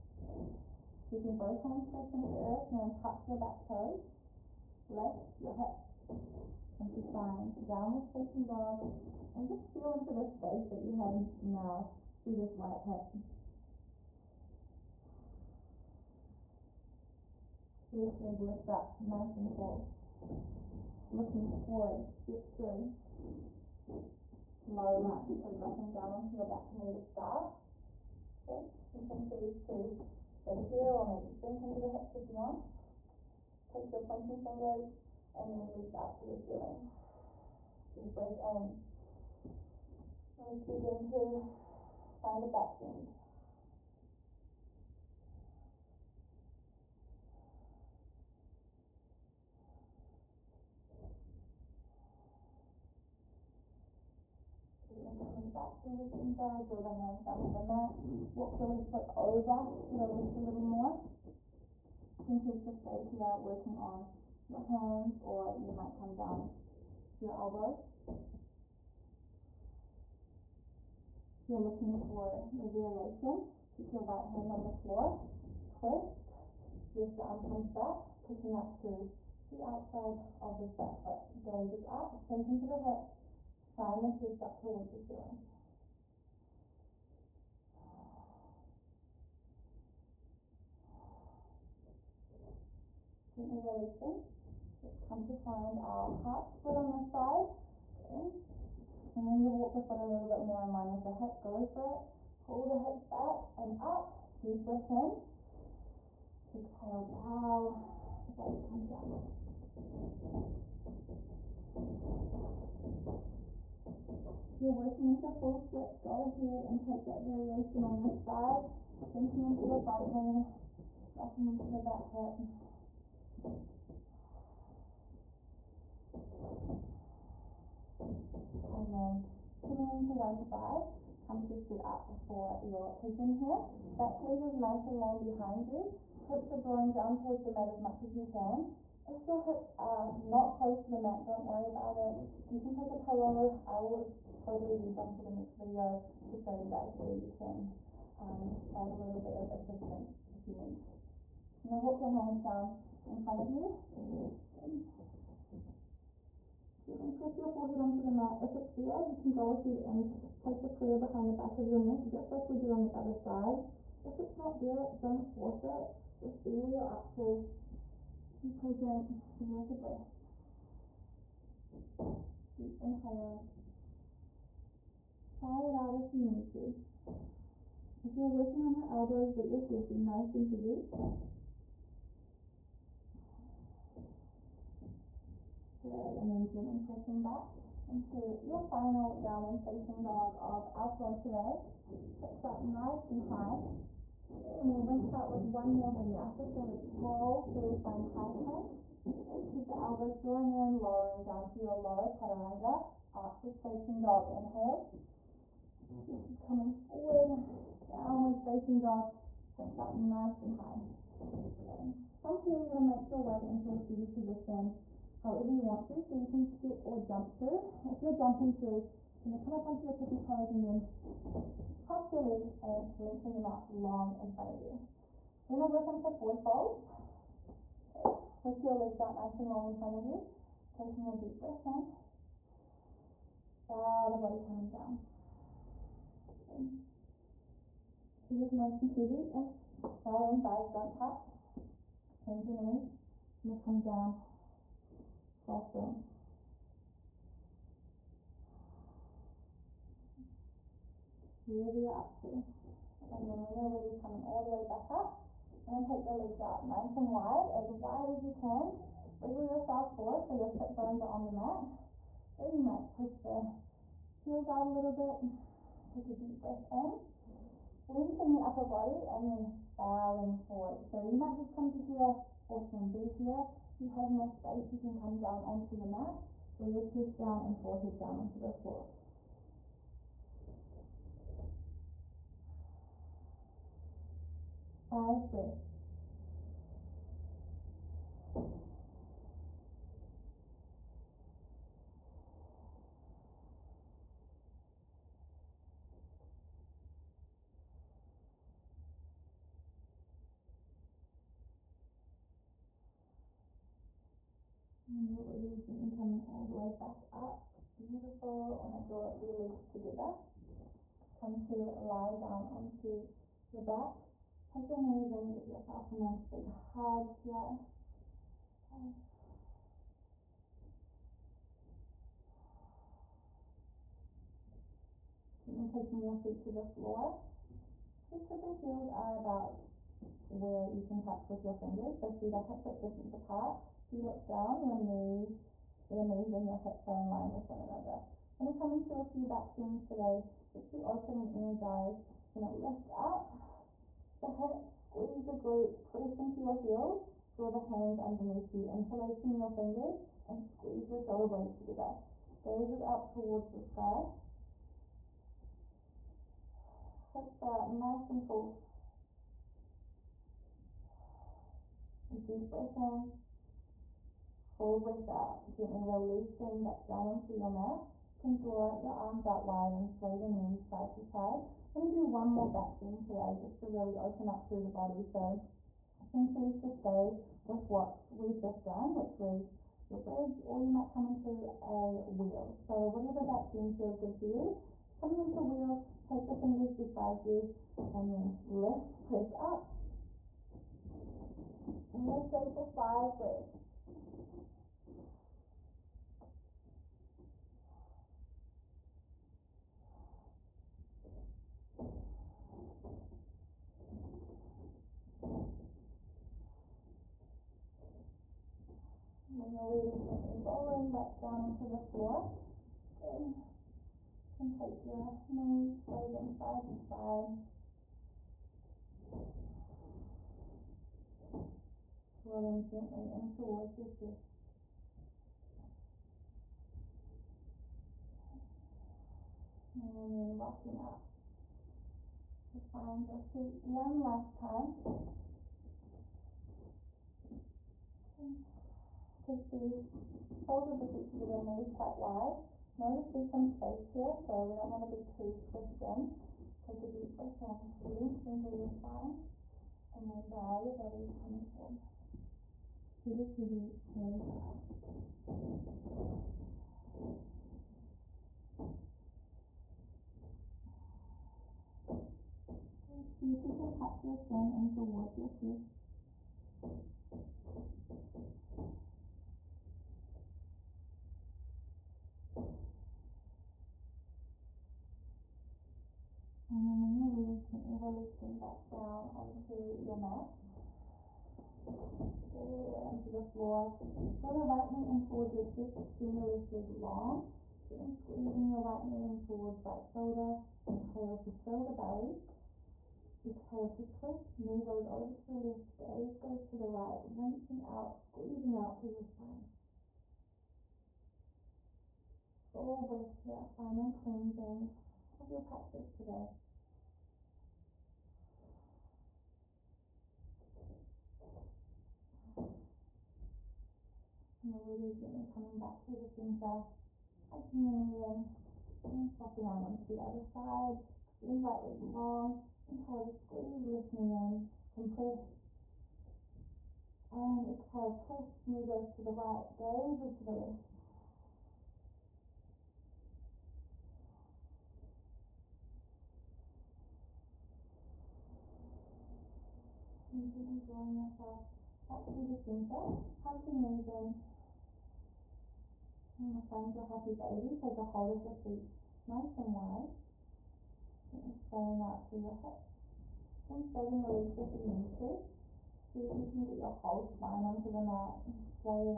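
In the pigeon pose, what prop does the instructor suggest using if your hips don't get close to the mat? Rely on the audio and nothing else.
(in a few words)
A pillow.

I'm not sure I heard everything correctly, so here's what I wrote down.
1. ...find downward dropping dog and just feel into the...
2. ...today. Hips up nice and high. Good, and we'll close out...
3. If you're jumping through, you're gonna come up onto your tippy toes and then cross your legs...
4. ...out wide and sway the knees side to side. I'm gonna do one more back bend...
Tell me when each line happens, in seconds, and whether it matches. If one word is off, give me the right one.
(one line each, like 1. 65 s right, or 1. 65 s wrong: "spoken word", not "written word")
1. 7 s wrong: "facing", not "dropping"
2. 191 s wrong: "rinse", not "close"
3. 217 s right
4. 369 s right.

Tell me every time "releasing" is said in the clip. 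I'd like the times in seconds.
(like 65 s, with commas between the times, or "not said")
93 s, 365 s, 477 s.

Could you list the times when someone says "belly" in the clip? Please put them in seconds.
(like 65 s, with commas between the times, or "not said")
240 s, 491 s.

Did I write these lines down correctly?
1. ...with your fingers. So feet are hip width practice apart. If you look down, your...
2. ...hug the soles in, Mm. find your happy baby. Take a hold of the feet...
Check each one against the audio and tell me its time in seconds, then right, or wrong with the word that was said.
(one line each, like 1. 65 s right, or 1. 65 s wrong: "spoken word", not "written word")
1. 331 s wrong: "distance", not "practice"
2. 543 s wrong: "knees", not "soles".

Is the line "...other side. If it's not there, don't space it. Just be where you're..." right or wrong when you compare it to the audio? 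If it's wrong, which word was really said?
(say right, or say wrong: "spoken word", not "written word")
wrong: "force", not "space".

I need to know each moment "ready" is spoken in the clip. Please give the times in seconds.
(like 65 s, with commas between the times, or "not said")
253 s, 305 s, 409 s, 477 s.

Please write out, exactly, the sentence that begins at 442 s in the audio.
Notice there's some space here, so we don't want to be too squished in.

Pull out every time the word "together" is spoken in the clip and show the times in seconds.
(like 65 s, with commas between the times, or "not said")
309 s, 351 s, 441 s.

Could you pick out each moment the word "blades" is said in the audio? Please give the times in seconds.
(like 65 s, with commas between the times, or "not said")
351 s.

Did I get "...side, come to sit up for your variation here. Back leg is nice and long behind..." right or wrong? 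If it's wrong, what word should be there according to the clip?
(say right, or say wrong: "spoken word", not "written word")
wrong: "pigeon", not "variation".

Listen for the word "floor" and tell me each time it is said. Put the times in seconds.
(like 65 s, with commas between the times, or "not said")
74 s, 278 s, 326 s, 411 s, 483 s.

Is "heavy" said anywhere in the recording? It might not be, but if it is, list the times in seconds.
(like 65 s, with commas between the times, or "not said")
180 s, 238 s, 453 s.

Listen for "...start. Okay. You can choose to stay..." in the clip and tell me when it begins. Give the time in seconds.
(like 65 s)
27 s.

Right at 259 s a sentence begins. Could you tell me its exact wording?
Wriggle yourself forward so your sit bones are on the mat.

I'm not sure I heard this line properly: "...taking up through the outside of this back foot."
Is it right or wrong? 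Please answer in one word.
wrong.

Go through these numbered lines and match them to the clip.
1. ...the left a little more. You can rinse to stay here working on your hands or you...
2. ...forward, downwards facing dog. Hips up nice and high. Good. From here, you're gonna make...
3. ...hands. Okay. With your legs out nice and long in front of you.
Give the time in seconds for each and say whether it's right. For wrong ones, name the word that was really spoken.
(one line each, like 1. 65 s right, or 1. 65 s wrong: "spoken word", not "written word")
1. 59 s wrong: "choose", not "rinse"
2. 206 s right
3. 226 s wrong: "folds", not "hands".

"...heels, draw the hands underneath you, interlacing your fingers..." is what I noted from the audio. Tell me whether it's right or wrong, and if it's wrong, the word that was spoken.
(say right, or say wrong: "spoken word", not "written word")
right.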